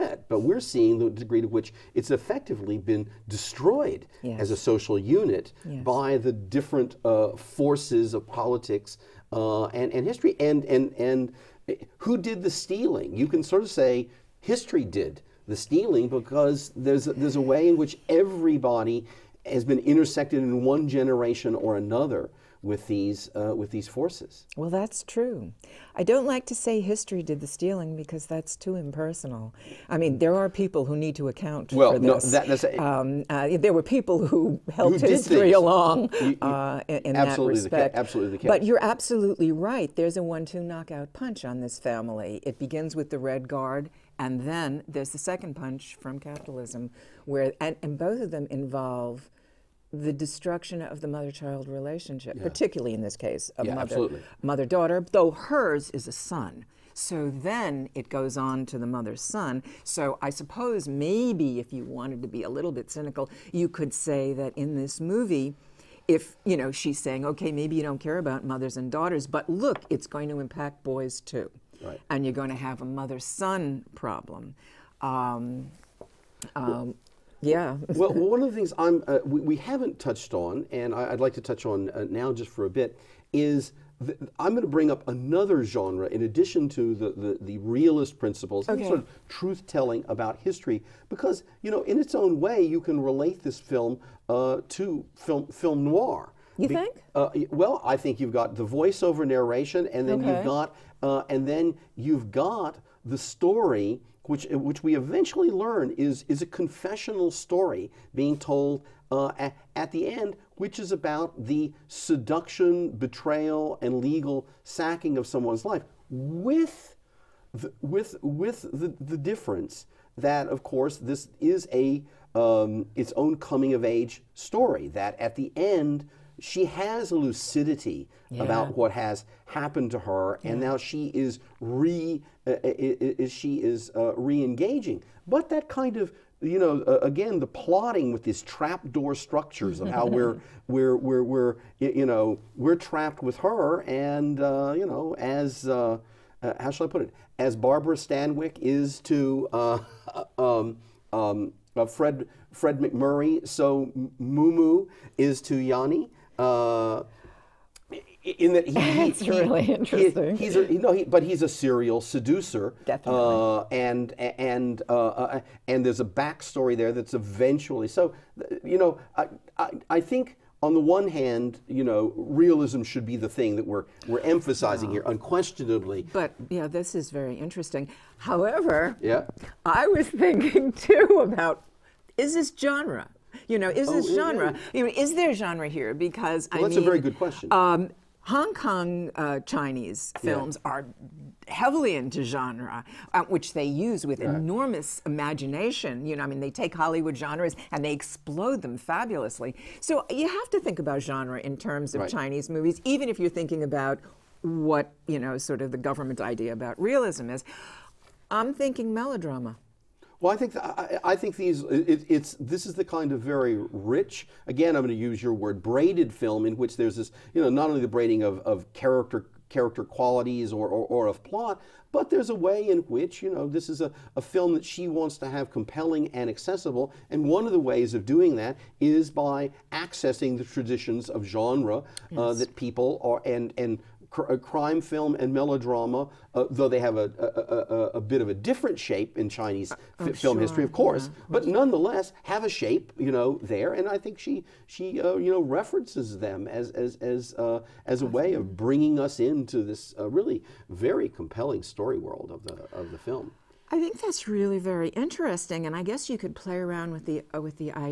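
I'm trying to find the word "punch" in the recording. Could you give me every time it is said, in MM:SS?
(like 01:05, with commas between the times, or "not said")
00:41, 00:45.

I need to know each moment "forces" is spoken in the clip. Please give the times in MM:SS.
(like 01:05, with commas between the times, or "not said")
00:07, 00:23.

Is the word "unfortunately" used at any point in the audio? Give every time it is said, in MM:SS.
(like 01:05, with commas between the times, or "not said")
not said.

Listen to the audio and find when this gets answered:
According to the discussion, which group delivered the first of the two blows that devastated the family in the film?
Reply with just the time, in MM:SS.
00:43.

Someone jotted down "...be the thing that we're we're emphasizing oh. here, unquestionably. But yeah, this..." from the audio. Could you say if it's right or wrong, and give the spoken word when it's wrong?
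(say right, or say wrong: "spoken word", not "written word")
right.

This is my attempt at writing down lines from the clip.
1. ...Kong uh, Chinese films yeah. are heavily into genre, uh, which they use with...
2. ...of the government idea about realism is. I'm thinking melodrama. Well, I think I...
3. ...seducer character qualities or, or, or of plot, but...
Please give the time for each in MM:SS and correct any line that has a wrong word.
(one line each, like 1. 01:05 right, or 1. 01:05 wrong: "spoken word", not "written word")
1. 03:08 right
2. 03:25 right
3. 03:38 wrong: "character", not "seducer".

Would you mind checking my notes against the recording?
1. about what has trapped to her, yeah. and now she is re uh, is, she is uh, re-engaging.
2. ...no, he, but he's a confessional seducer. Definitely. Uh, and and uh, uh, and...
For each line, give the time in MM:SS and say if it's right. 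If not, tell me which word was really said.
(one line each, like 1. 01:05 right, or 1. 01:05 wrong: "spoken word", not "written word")
1. 02:08 wrong: "happened", not "trapped"
2. 02:40 wrong: "serial", not "confessional".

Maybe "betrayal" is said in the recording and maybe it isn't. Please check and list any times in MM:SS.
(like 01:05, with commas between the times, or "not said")
01:52.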